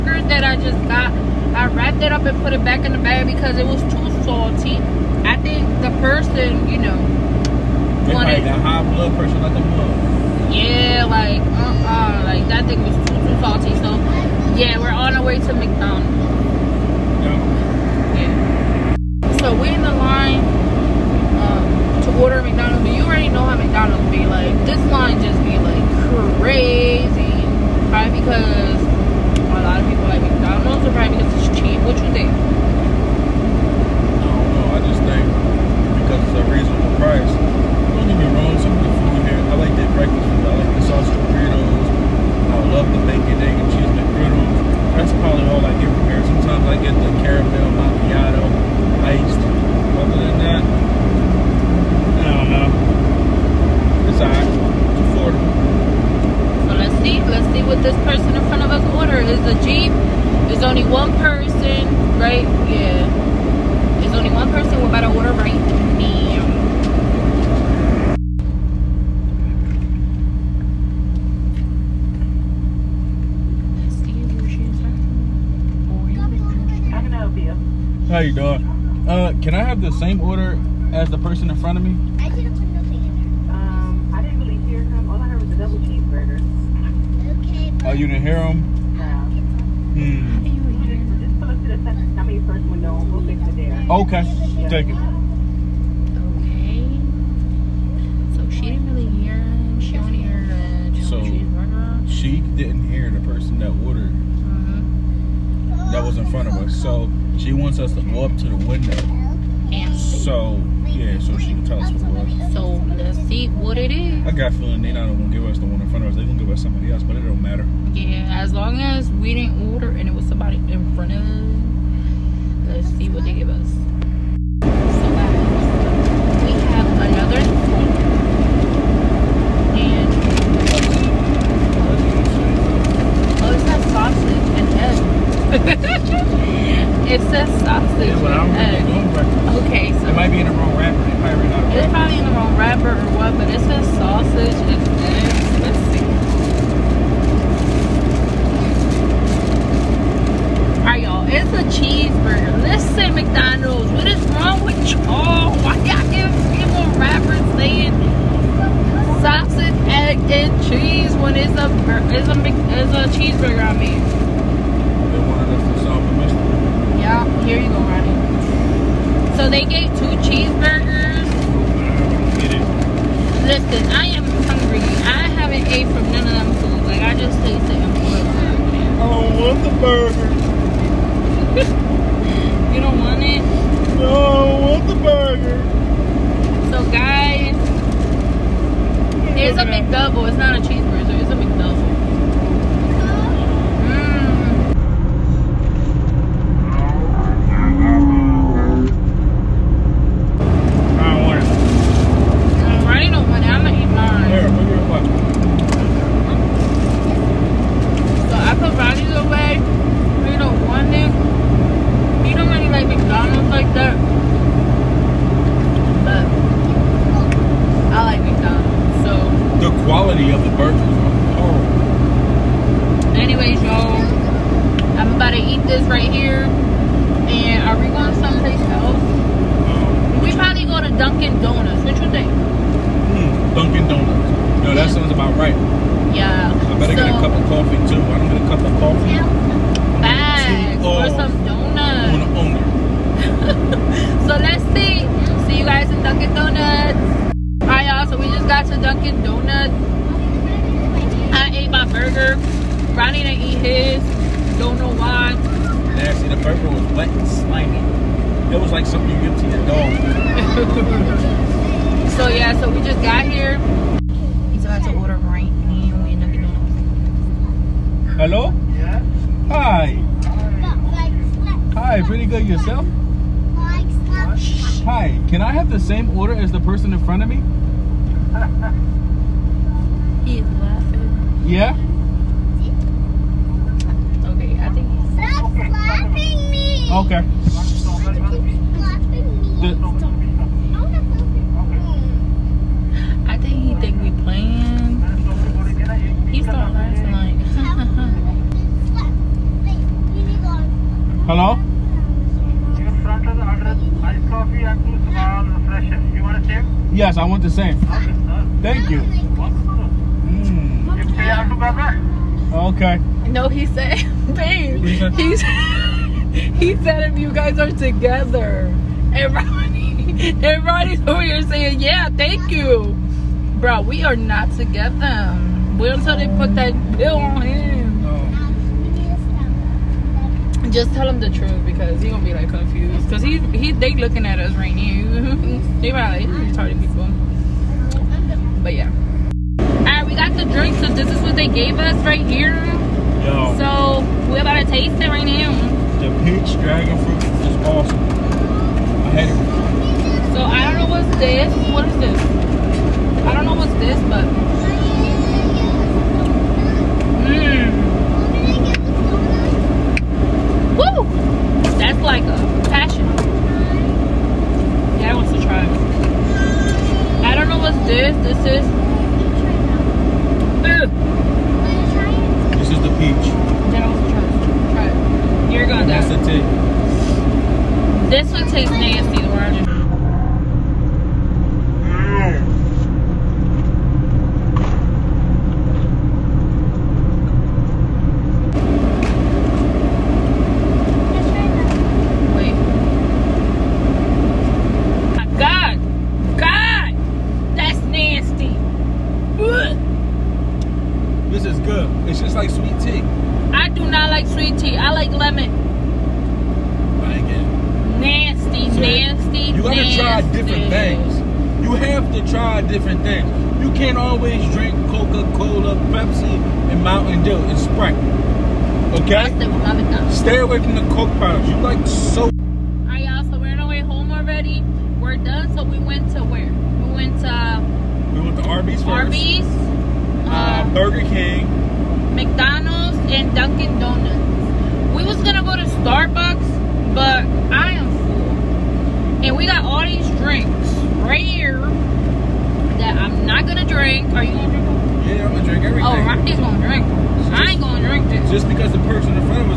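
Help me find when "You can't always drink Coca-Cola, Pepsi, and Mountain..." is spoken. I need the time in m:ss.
6:53.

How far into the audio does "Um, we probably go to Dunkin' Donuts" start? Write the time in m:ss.
3:48.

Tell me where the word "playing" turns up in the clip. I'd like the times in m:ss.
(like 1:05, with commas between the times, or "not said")
4:54.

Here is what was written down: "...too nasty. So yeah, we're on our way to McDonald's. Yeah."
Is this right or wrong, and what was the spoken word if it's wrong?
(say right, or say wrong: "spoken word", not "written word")
wrong: "salty", not "nasty".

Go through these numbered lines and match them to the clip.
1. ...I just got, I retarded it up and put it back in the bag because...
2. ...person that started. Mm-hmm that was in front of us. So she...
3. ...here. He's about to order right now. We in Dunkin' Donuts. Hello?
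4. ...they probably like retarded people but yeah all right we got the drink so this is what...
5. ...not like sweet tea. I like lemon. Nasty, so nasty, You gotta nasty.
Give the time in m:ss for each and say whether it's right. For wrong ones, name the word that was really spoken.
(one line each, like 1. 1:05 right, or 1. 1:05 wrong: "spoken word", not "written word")
1. 0:00 wrong: "wrapped", not "retarded"
2. 1:43 wrong: "ordered", not "started"
3. 4:23 right
4. 5:35 right
5. 6:43 right.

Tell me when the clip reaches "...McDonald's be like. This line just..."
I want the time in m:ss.
0:23.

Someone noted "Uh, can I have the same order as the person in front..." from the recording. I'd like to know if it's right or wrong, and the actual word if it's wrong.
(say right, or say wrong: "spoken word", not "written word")
right.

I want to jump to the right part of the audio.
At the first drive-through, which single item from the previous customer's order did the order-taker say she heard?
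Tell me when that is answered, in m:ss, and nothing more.
1:25.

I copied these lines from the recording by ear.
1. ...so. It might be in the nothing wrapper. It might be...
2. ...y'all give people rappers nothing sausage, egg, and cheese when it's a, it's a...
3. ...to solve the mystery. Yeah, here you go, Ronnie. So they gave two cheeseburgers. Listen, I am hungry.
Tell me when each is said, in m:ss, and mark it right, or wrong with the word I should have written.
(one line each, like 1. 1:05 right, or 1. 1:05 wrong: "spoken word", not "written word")
1. 2:19 wrong: "wrong", not "nothing"
2. 2:35 wrong: "saying", not "nothing"
3. 2:45 right.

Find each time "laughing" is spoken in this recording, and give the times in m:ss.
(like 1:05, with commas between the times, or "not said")
4:40, 4:56.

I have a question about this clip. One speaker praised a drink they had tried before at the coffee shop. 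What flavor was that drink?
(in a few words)
peach dragon fruit.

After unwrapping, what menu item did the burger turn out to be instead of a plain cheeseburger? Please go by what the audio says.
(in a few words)
McDouble.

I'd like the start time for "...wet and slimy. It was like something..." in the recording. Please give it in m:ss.
4:16.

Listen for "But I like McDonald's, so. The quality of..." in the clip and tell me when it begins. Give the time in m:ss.
3:36.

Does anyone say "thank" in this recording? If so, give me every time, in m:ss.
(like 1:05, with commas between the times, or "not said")
1:34, 5:08, 5:22.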